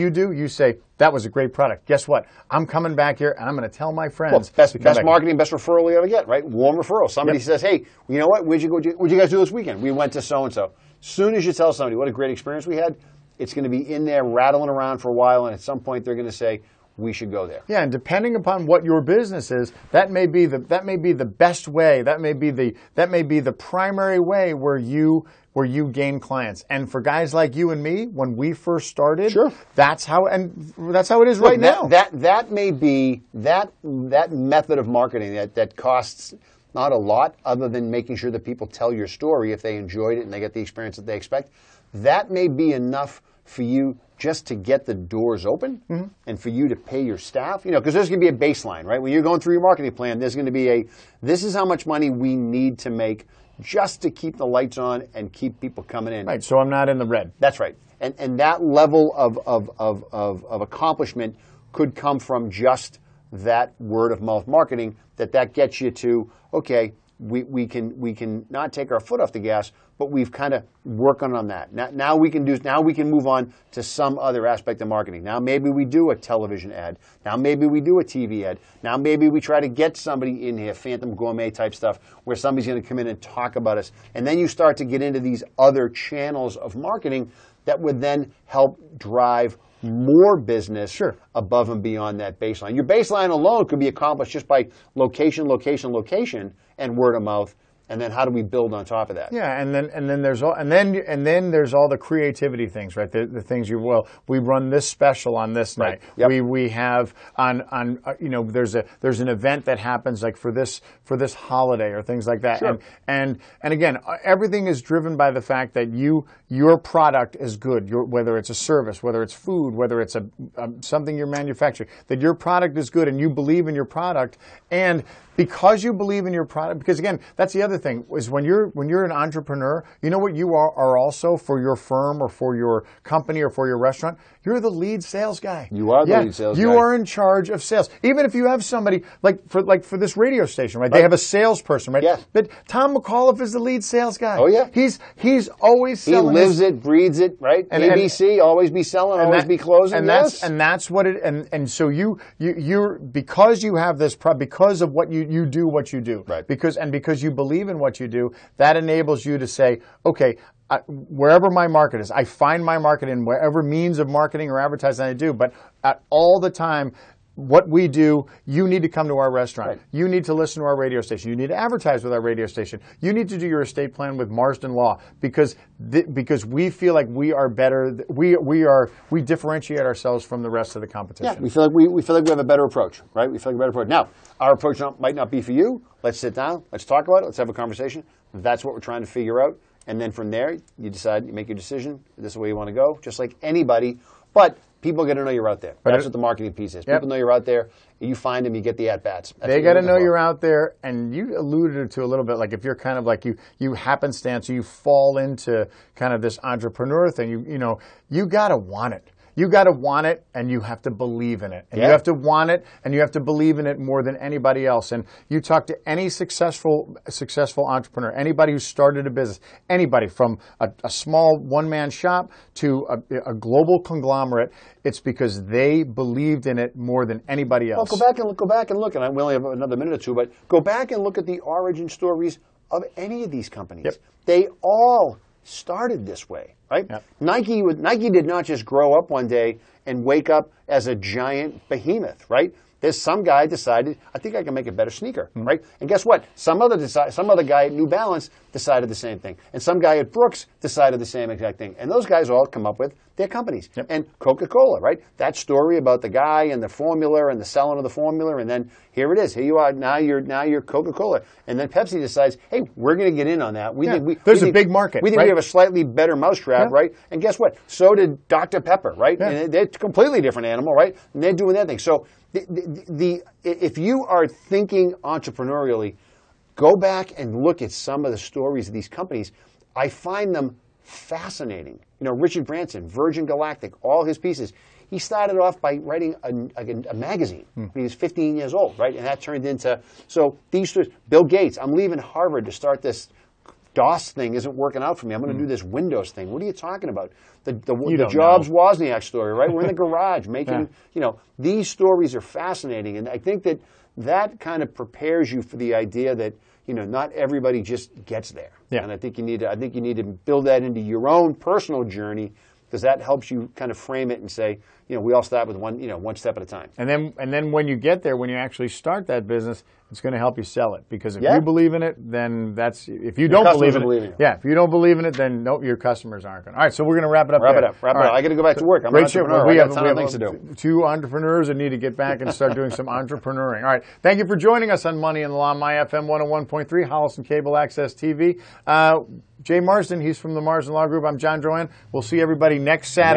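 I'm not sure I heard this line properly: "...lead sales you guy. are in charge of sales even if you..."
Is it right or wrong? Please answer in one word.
right.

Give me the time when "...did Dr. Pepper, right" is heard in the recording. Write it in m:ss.
4:27.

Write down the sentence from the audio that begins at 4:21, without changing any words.
And then Pepsi decides, hey, we're going to get in on that.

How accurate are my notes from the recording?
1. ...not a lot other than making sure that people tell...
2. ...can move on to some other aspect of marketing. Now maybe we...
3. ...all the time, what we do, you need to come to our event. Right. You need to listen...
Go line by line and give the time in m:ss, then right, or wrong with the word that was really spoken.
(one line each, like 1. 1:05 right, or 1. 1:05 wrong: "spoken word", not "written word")
1. 0:36 right
2. 1:12 right
3. 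2:46 wrong: "restaurant", not "event".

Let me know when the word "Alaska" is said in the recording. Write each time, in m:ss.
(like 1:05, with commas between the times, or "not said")
not said.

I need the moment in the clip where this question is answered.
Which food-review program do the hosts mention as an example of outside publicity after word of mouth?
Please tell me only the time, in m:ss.
1:20.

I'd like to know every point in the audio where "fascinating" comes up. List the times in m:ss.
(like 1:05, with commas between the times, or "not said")
4:40, 5:02.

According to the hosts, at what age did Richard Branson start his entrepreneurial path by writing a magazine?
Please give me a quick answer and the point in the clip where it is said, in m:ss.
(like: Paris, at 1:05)
15, at 4:47.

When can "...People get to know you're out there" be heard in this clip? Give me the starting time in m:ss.
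3:14.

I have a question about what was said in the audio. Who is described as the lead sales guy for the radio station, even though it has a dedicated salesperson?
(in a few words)
Tom McAuliffe.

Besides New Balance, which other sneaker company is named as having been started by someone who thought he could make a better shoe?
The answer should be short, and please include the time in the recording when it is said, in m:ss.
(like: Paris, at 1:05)
Brooks, at 4:10.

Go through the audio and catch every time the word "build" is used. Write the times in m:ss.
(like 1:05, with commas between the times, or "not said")
1:38, 5:10.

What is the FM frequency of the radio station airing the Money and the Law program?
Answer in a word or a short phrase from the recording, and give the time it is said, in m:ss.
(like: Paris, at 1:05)
101.3, at 5:36.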